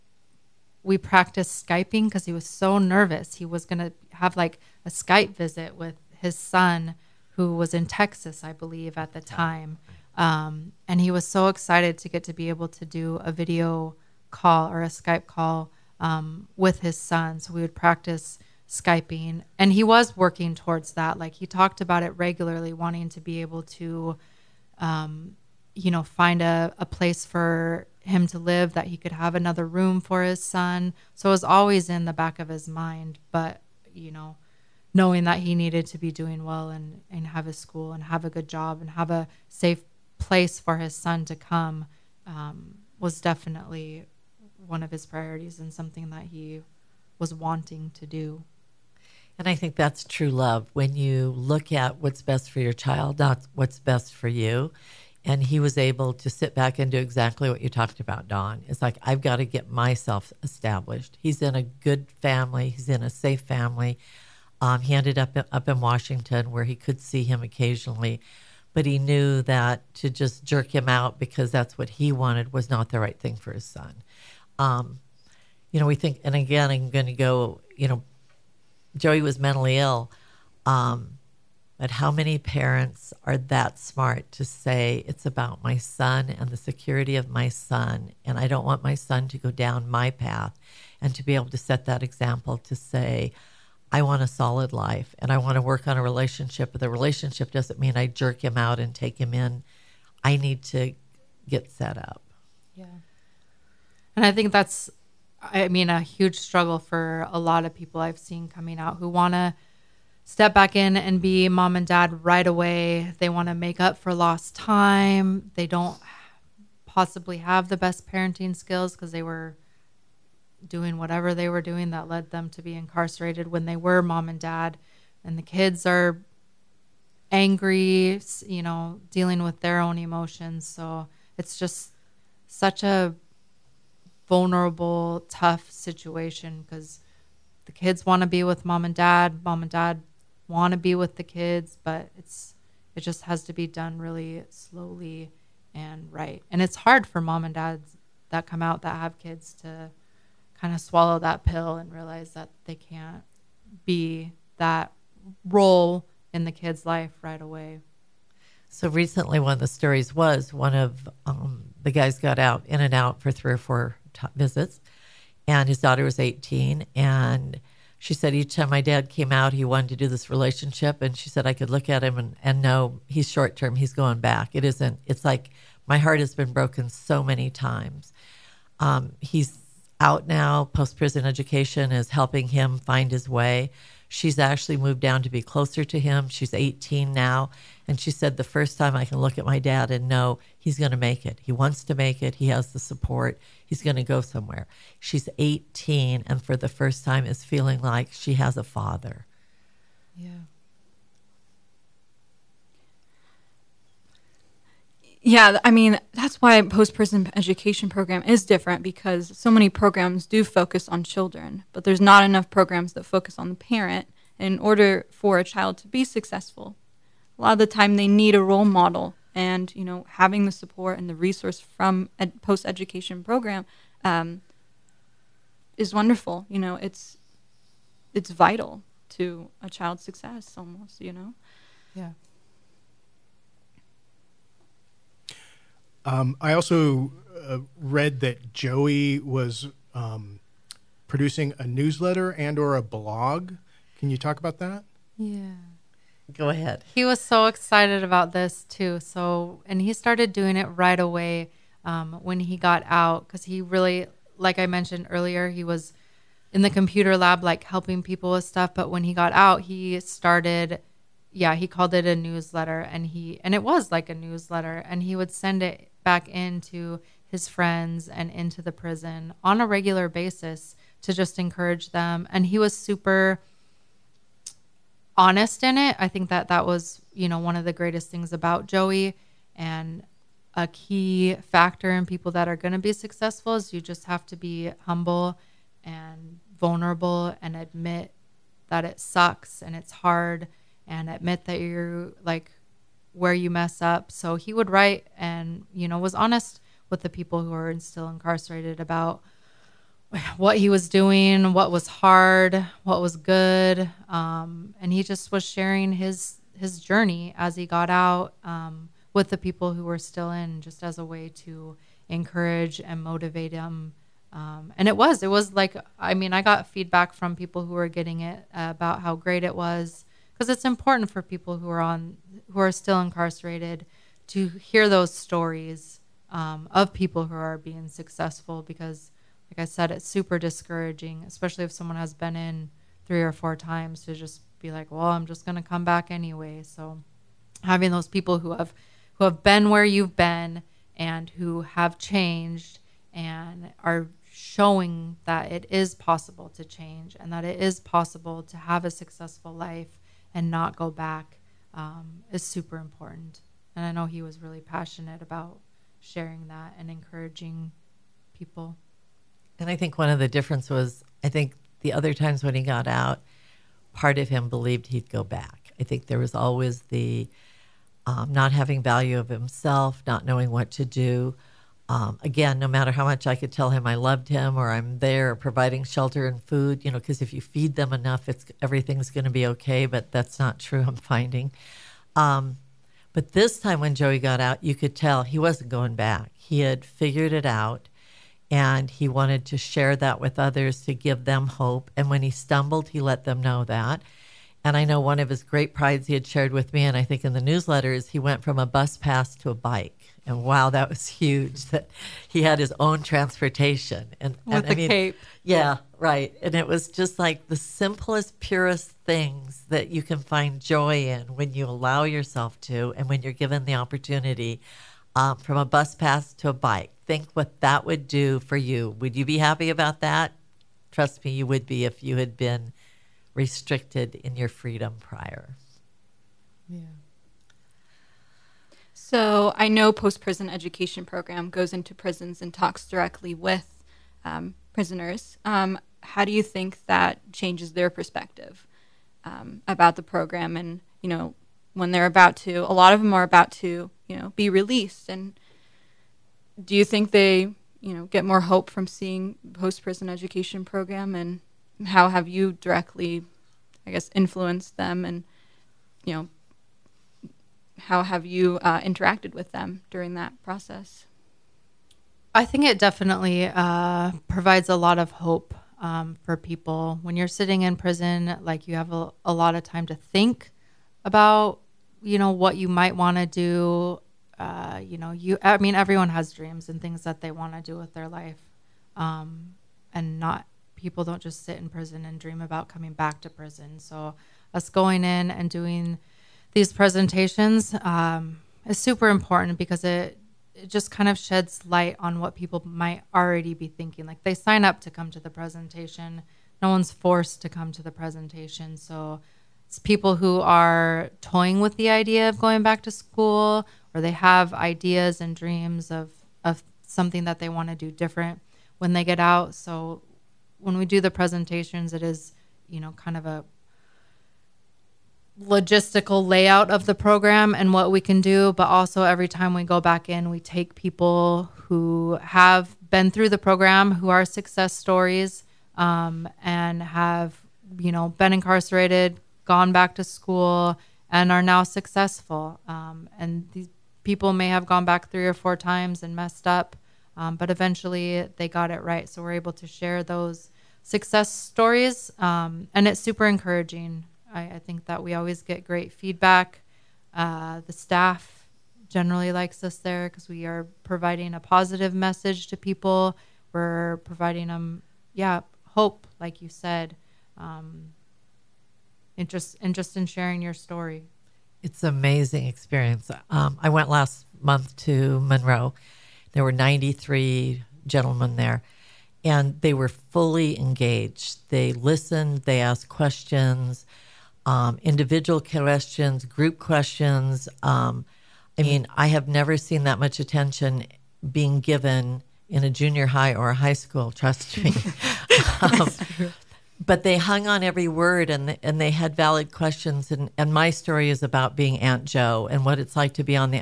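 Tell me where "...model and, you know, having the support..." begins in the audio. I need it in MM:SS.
03:38.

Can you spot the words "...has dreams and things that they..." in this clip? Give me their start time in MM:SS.
07:56.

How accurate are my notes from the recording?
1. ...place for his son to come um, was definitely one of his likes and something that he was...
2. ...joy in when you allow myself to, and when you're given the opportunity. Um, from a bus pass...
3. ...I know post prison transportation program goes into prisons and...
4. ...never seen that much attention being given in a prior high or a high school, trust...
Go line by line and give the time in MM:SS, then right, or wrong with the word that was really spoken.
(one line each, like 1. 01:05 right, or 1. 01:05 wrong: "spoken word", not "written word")
1. 00:40 wrong: "priorities", not "likes"
2. 06:50 wrong: "yourself", not "myself"
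3. 07:09 wrong: "education", not "transportation"
4. 09:39 wrong: "junior", not "prior".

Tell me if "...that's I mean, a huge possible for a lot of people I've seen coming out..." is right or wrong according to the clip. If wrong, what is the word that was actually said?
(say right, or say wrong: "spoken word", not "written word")
wrong: "struggle", not "possible".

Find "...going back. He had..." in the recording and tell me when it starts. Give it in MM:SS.
06:25.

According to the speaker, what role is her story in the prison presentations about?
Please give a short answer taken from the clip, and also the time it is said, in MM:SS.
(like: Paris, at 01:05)
Aunt Joe, at 09:51.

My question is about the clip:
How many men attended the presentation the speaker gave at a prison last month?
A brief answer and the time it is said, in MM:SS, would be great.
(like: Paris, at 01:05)
93, at 09:26.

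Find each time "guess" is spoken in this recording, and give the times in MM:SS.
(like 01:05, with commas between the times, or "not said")
07:33.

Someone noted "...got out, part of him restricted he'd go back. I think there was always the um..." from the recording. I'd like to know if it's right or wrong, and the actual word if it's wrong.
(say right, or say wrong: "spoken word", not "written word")
wrong: "believed", not "restricted".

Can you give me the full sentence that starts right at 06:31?
And when he stumbled, he let them know that.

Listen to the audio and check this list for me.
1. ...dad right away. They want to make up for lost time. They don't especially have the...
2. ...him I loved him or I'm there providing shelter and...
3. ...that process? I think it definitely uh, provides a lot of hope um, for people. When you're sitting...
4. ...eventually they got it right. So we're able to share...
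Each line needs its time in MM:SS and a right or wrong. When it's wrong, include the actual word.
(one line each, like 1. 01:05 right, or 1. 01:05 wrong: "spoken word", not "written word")
1. 01:51 wrong: "possibly", not "especially"
2. 06:13 right
3. 07:40 right
4. 08:57 right.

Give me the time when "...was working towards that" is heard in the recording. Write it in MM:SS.
00:19.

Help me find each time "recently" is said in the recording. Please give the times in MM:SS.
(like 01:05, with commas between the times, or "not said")
02:38.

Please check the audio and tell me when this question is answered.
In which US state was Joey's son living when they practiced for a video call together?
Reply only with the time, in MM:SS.
00:07.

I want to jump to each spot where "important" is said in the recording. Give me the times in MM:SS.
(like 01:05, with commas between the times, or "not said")
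05:20, 05:52, 08:09.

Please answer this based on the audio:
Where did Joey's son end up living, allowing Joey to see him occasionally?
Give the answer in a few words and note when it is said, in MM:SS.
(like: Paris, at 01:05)
Washington, at 01:05.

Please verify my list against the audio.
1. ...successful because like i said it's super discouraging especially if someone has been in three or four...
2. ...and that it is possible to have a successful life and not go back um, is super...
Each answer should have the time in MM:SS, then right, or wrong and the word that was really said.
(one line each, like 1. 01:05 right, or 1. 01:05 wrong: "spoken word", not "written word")
1. 05:27 right
2. 05:47 right.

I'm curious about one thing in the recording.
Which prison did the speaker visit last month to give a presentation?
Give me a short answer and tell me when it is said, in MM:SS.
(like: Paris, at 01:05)
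Monroe, at 09:25.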